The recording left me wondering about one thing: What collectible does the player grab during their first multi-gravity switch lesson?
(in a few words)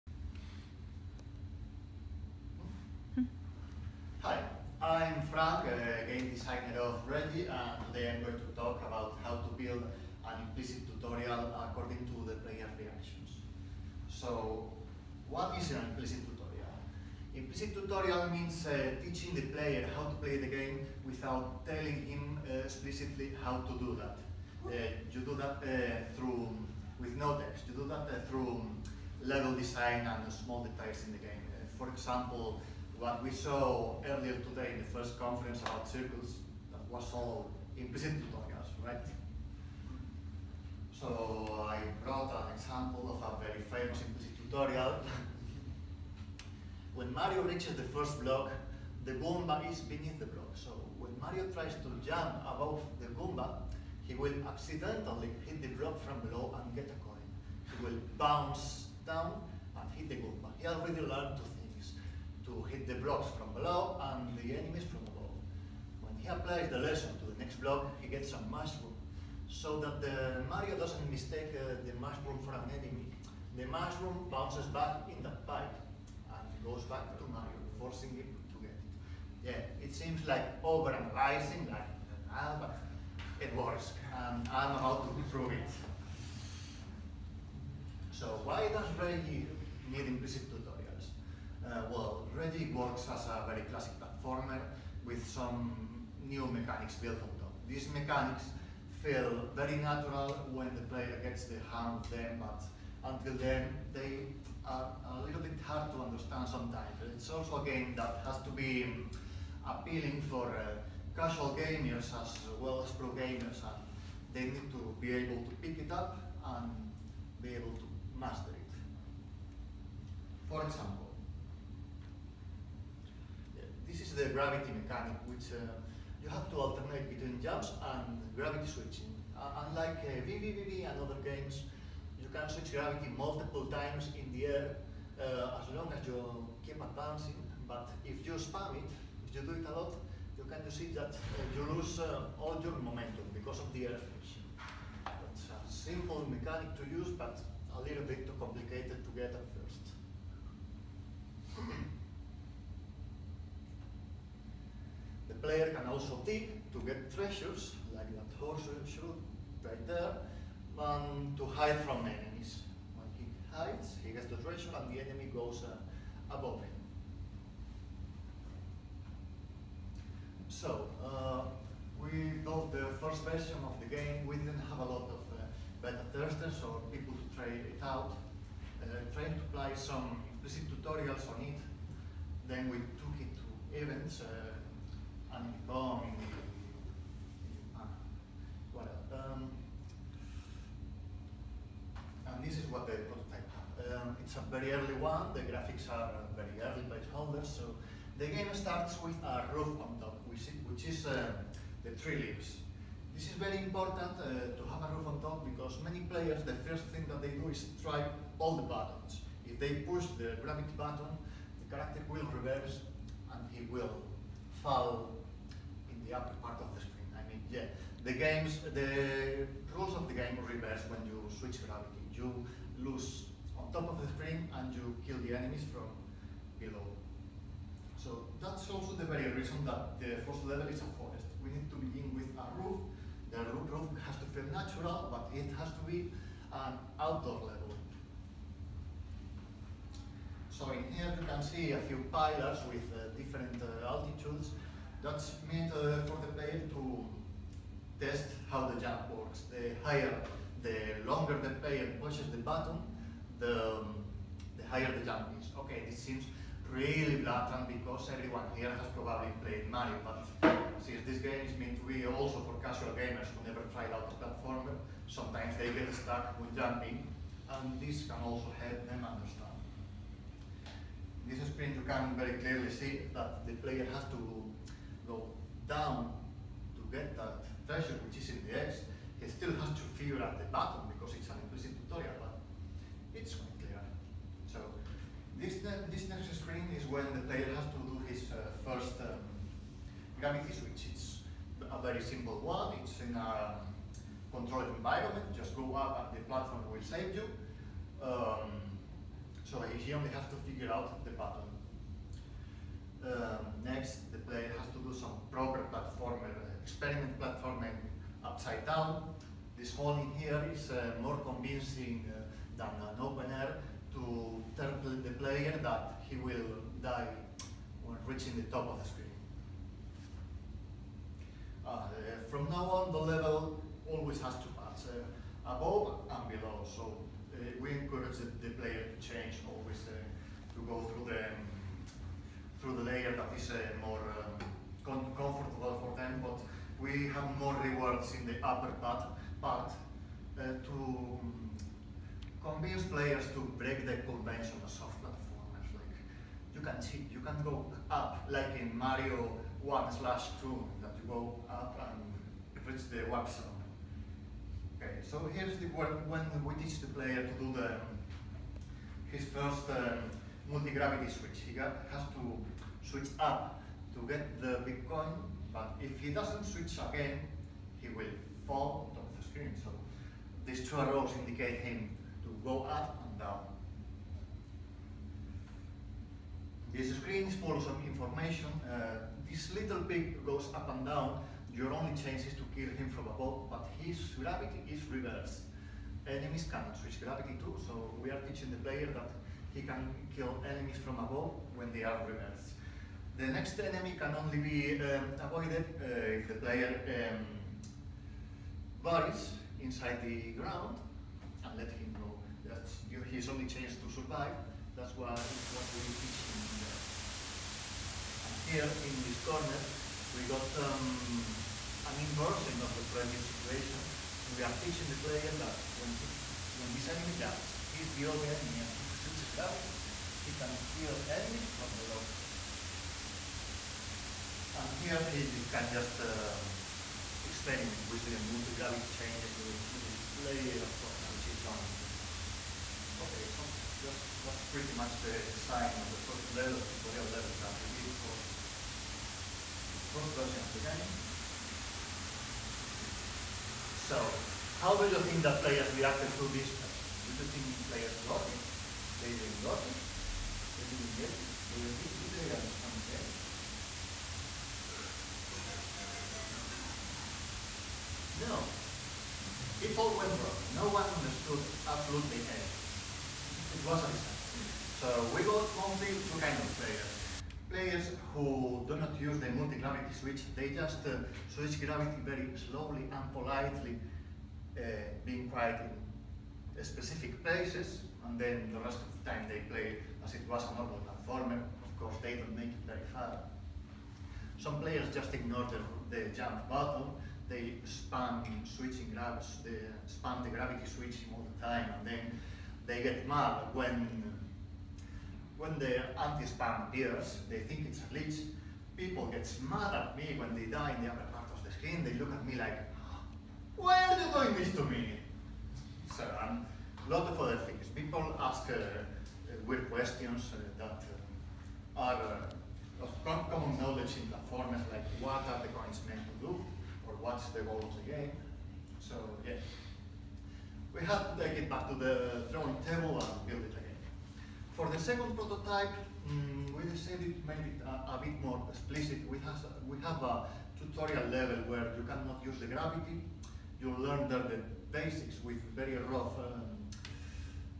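Bitcoin.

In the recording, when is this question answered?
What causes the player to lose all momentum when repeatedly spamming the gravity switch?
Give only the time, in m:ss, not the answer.
2:23.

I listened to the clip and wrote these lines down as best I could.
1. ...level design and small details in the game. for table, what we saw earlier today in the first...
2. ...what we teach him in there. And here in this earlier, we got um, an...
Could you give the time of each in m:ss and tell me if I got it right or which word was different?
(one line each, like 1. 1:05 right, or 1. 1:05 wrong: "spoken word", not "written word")
1. 0:29 wrong: "example", not "table"
2. 6:45 wrong: "corner", not "earlier".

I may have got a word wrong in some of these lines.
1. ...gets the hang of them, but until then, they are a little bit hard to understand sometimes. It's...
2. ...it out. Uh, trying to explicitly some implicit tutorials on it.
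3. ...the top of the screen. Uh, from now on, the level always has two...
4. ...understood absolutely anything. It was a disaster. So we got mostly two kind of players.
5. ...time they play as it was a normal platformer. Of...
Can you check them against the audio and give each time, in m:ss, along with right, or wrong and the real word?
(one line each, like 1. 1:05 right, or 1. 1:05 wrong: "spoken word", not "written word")
1. 1:41 right
2. 2:57 wrong: "apply", not "explicitly"
3. 5:18 right
4. 7:40 right
5. 7:59 right.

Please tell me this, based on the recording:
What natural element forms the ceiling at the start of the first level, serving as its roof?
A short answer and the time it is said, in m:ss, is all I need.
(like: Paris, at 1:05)
tree leaves, at 3:21.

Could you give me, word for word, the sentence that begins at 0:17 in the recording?
Implicit tutorial means uh, teaching the player how to play the game without telling him uh, explicitly how to do that.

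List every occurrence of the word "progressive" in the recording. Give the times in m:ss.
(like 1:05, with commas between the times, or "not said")
not said.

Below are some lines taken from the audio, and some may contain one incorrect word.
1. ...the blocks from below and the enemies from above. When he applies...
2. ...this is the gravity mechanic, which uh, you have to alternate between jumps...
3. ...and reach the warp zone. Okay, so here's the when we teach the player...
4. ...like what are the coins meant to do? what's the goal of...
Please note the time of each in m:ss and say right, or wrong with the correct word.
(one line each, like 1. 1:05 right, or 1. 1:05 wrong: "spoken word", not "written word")
1. 1:02 right
2. 2:03 right
3. 5:51 right
4. 8:34 right.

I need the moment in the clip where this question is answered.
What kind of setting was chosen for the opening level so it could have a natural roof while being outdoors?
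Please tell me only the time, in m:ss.
3:50.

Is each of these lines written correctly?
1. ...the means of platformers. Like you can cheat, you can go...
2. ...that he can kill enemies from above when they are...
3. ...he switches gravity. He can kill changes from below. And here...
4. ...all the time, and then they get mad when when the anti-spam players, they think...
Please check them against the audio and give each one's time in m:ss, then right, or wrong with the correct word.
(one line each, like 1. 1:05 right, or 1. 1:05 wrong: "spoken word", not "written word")
1. 5:43 wrong: "conventions", not "means"
2. 6:28 right
3. 6:58 wrong: "enemies", not "changes"
4. 8:11 wrong: "appears", not "players".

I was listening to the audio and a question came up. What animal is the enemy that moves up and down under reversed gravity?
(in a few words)
pig.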